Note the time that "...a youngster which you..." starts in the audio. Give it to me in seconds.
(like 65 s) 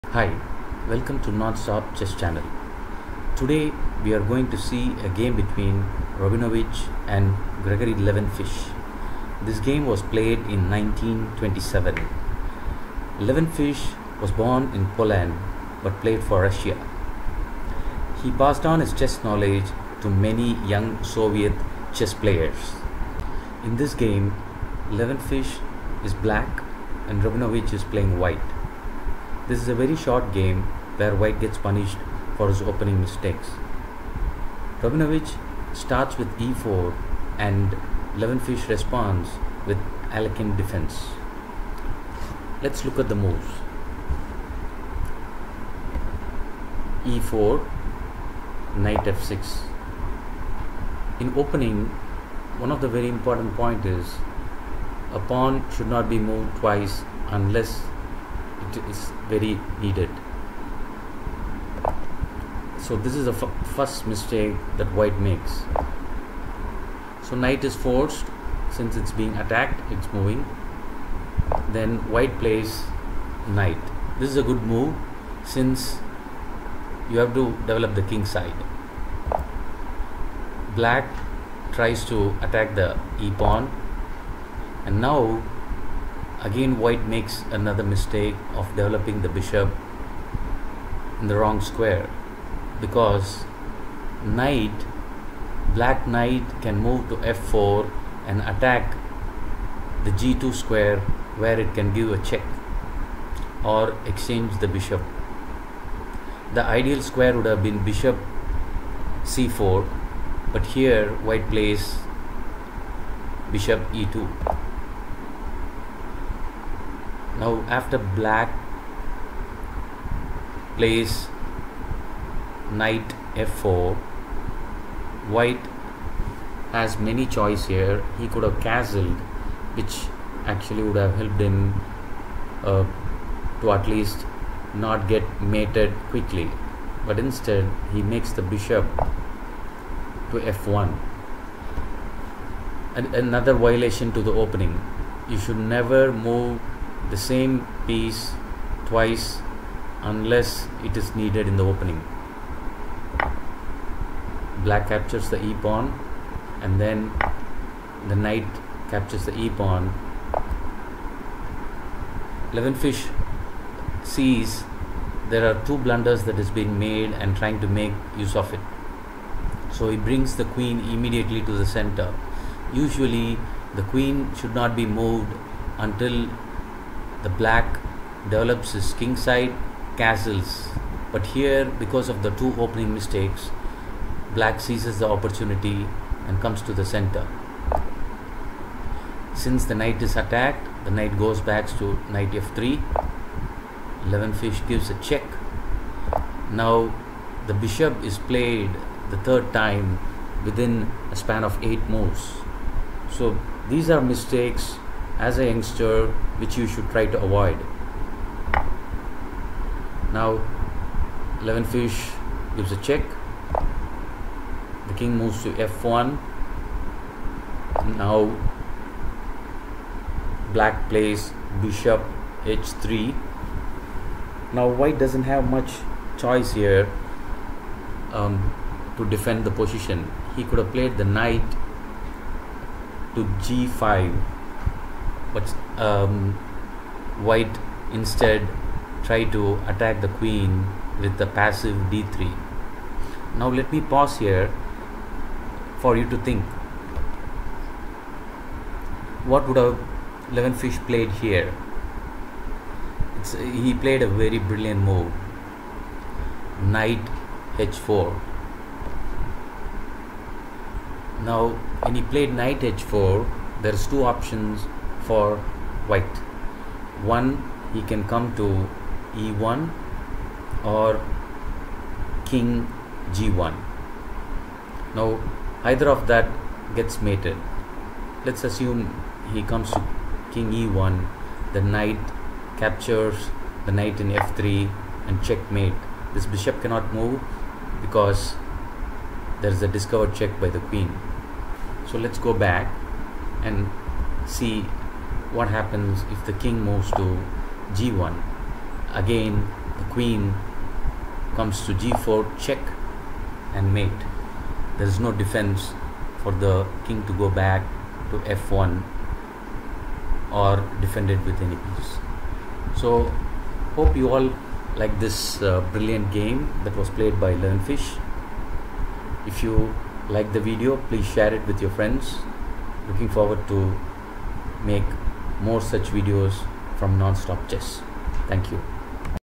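205 s.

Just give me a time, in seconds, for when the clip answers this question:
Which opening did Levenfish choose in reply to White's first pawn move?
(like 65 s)
40 s.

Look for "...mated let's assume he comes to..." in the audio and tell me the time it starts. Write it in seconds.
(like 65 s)
277 s.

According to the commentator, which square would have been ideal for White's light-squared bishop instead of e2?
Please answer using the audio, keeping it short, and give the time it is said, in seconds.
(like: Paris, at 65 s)
c4, at 107 s.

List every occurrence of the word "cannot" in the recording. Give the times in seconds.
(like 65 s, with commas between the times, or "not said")
286 s.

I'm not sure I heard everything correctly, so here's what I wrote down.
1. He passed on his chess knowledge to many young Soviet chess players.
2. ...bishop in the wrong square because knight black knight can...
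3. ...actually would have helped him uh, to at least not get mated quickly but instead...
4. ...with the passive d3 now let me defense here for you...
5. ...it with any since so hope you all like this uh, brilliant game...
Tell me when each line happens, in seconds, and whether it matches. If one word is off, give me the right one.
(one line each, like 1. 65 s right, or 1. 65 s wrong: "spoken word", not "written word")
1. 18 s right
2. 89 s right
3. 130 s right
4. 240 s wrong: "pause", not "defense"
5. 311 s wrong: "piece", not "since".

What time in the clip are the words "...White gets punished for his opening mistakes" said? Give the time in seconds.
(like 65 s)
31 s.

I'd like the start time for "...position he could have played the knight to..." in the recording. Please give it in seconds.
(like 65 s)
229 s.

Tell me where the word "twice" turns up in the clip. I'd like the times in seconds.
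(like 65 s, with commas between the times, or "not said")
56 s, 148 s.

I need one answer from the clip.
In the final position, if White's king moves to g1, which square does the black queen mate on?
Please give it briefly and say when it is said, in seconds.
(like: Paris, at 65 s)
g4, at 301 s.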